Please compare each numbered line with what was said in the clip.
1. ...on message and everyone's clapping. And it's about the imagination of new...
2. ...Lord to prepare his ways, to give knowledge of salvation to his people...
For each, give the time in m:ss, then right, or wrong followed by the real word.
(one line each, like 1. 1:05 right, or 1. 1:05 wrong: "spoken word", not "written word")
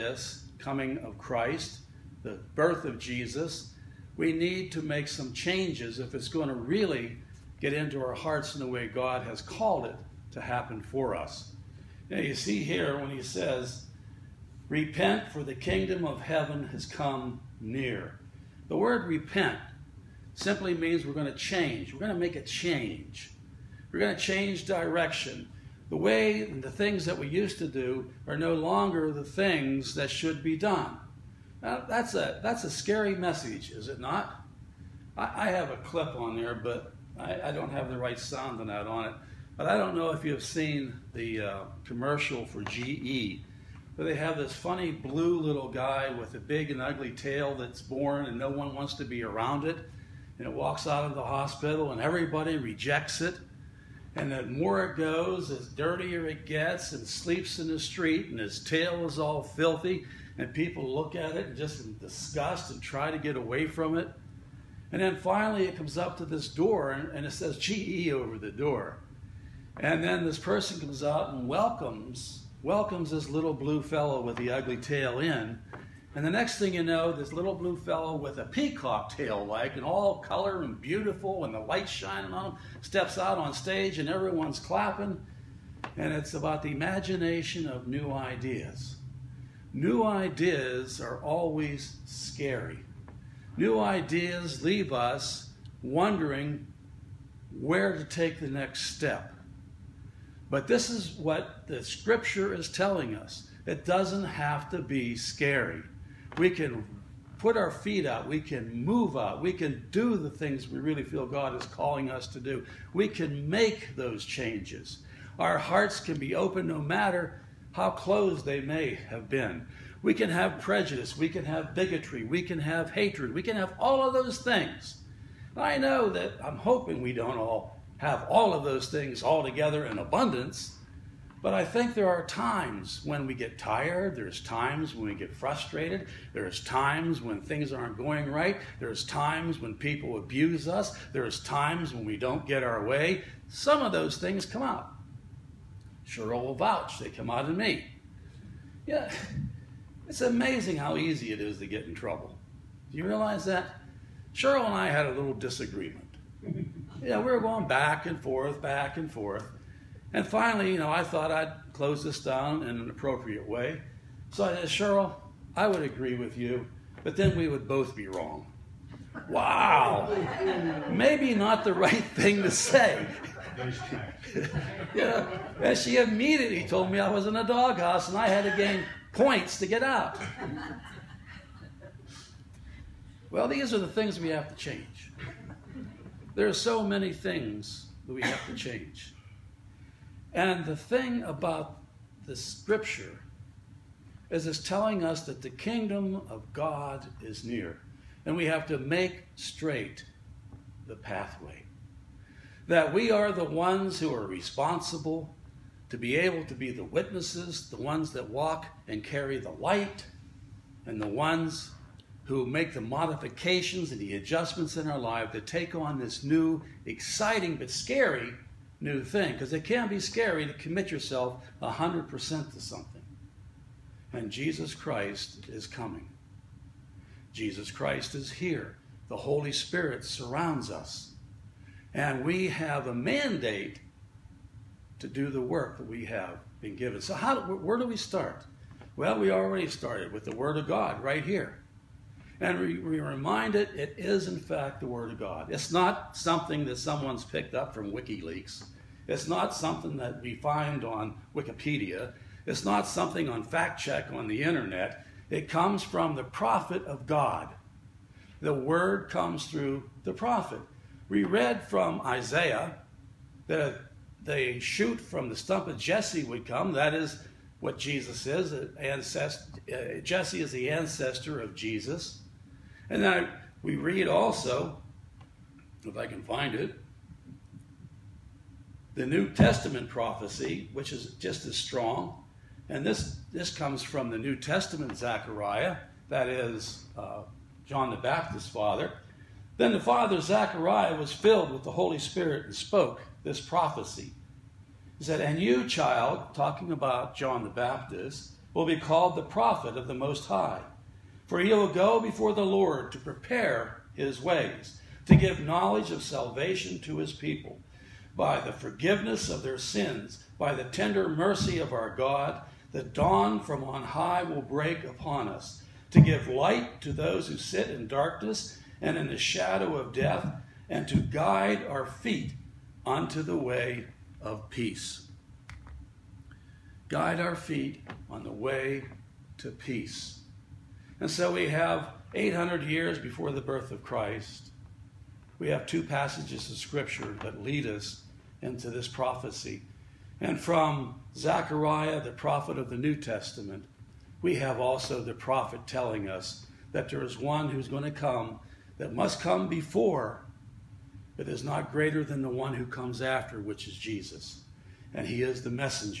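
1. 1:23 wrong: "stage", not "message"
2. 5:02 right.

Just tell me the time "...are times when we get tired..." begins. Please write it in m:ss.
2:12.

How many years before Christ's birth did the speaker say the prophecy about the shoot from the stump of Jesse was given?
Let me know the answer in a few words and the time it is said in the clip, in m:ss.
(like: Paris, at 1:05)
800, at 5:32.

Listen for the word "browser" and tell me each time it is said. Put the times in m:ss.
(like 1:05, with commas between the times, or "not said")
not said.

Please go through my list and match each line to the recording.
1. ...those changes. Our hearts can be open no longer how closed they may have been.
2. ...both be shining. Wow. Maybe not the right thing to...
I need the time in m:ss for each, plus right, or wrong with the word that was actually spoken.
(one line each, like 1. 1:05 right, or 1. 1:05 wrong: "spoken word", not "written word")
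1. 1:53 wrong: "matter", not "longer"
2. 2:47 wrong: "wrong", not "shining".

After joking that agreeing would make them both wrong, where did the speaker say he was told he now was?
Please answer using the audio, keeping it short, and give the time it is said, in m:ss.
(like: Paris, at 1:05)
In a doghouse, at 2:57.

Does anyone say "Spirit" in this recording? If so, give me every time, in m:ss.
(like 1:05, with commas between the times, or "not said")
3:49, 4:51.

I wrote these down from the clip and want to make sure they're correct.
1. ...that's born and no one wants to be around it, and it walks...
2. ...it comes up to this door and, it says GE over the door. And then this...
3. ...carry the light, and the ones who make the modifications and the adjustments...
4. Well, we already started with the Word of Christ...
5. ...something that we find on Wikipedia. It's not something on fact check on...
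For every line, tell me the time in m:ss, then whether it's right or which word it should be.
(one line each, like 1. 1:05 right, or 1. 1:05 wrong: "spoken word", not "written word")
1. 0:47 right
2. 1:05 right
3. 3:29 right
4. 3:58 wrong: "God", not "Christ"
5. 4:09 right.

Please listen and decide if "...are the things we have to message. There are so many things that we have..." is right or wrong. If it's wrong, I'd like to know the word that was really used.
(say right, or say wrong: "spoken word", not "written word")
wrong: "change", not "message".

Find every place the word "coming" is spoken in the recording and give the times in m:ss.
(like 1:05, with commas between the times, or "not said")
0:00, 3:45.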